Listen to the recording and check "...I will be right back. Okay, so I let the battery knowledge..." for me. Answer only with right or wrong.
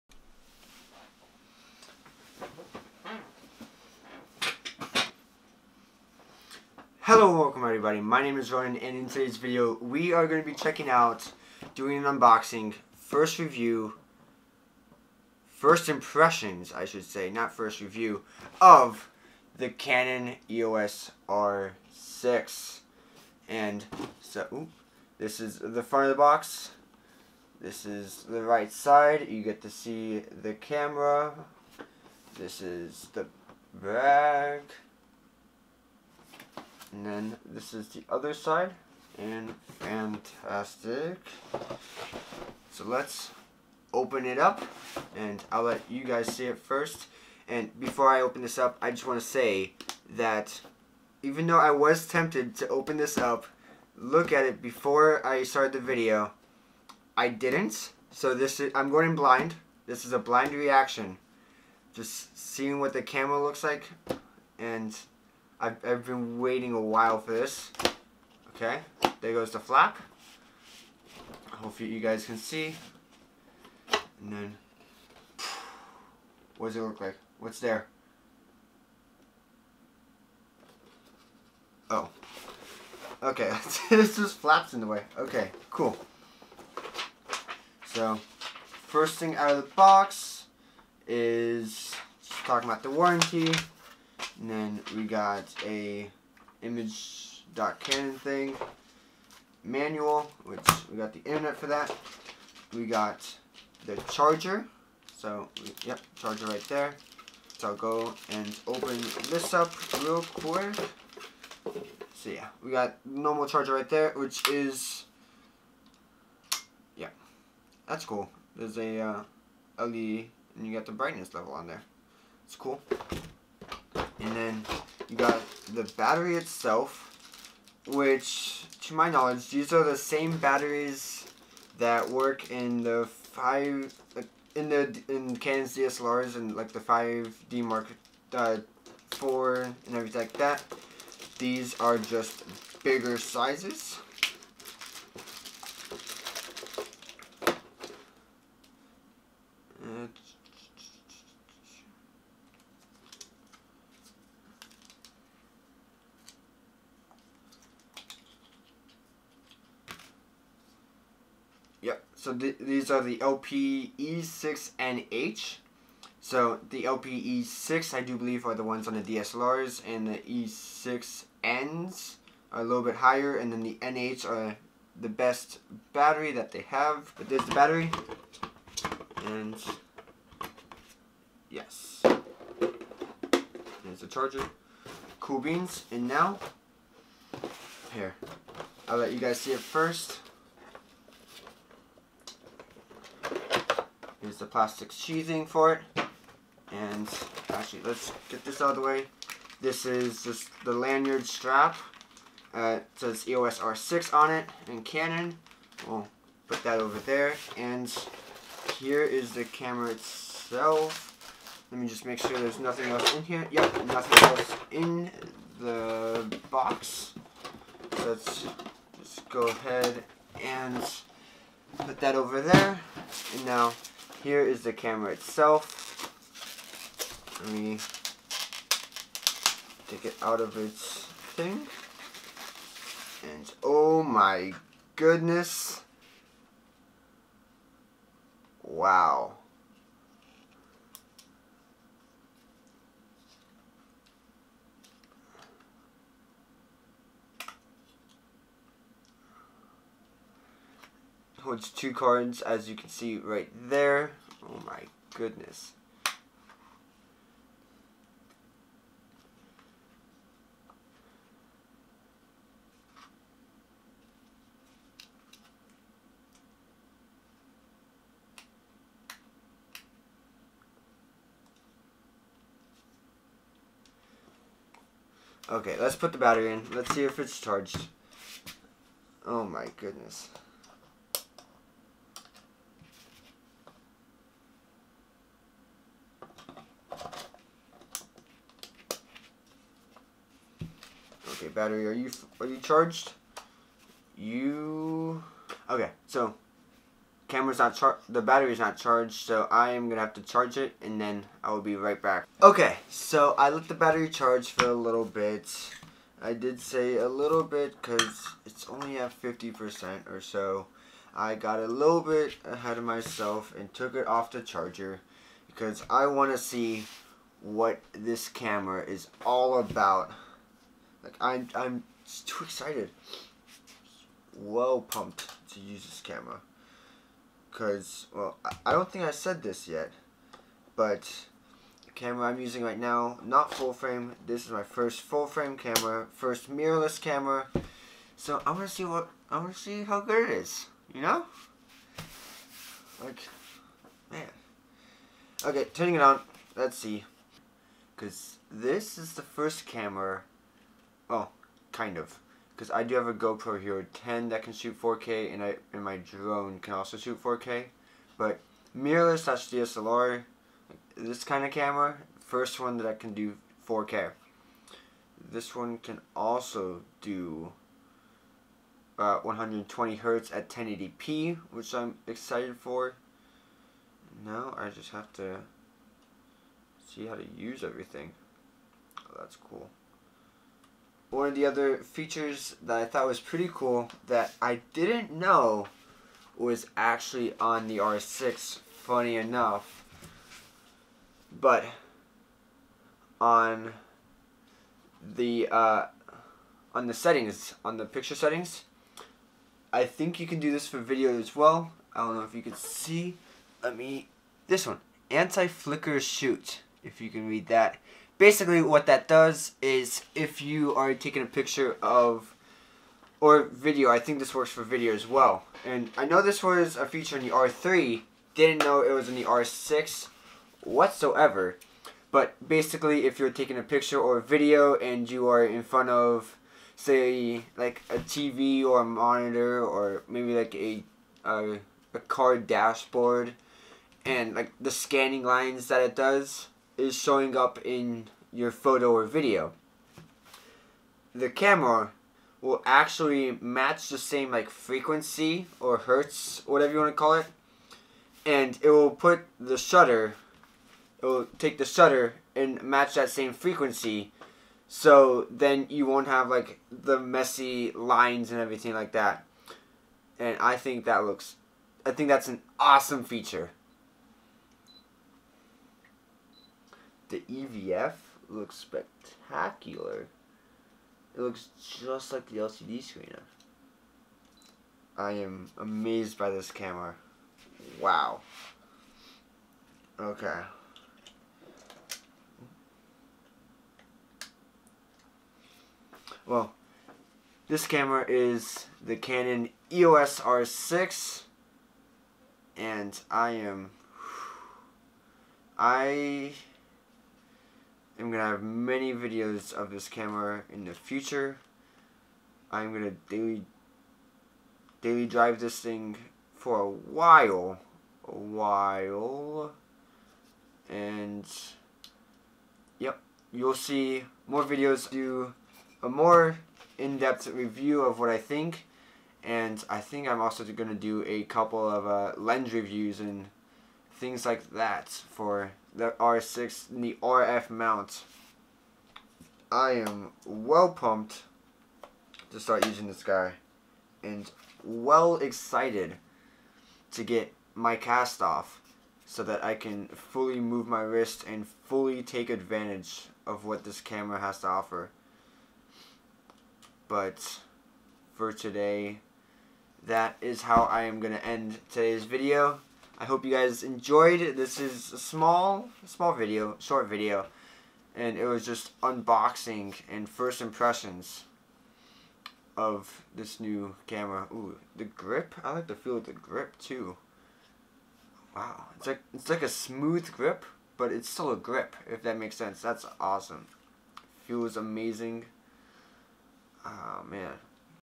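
wrong.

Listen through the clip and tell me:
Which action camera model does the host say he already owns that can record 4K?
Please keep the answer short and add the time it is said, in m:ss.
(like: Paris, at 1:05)
GoPro Hero 10, at 5:53.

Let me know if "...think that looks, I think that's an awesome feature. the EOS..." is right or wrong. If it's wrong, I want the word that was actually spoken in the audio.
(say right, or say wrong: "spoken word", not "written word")
wrong: "EVF", not "EOS".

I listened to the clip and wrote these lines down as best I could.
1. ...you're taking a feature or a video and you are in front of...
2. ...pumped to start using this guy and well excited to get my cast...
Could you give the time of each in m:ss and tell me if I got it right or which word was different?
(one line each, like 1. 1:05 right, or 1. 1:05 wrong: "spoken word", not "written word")
1. 7:03 wrong: "picture", not "feature"
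2. 8:50 right.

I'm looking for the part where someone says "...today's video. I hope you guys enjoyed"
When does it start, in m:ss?
9:11.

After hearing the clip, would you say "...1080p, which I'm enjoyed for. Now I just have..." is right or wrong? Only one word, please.
wrong.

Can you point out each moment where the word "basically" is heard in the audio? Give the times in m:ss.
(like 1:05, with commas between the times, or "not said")
6:48, 7:02.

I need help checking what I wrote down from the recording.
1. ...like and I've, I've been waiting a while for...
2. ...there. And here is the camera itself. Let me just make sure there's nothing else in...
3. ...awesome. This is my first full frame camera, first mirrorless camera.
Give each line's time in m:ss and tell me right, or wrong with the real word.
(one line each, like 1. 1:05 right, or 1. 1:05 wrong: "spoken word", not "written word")
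1. 1:03 right
2. 3:26 right
3. 5:33 wrong: "frame", not "awesome".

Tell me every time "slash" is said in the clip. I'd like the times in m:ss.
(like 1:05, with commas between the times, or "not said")
5:59.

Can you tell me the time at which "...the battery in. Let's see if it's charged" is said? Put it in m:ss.
4:36.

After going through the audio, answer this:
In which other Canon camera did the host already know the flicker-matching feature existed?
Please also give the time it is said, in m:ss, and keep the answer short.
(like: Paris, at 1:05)
R3, at 6:57.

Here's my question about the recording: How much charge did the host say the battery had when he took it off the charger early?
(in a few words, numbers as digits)
50%.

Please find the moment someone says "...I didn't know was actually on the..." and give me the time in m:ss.
6:24.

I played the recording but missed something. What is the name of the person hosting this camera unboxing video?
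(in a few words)
Rownan.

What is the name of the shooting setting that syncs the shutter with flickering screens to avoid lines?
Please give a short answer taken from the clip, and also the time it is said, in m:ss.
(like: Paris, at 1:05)
anti-flicker shoot, at 6:45.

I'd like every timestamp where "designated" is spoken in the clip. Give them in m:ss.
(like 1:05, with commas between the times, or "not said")
not said.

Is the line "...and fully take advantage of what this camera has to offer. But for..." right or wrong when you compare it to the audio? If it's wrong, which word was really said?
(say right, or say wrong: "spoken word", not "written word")
right.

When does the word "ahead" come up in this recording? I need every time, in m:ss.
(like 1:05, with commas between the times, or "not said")
3:39, 5:12.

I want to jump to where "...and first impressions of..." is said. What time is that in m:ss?
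9:19.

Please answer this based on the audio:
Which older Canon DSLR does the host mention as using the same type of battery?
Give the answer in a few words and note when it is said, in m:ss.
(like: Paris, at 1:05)
5D Mark IV, at 2:16.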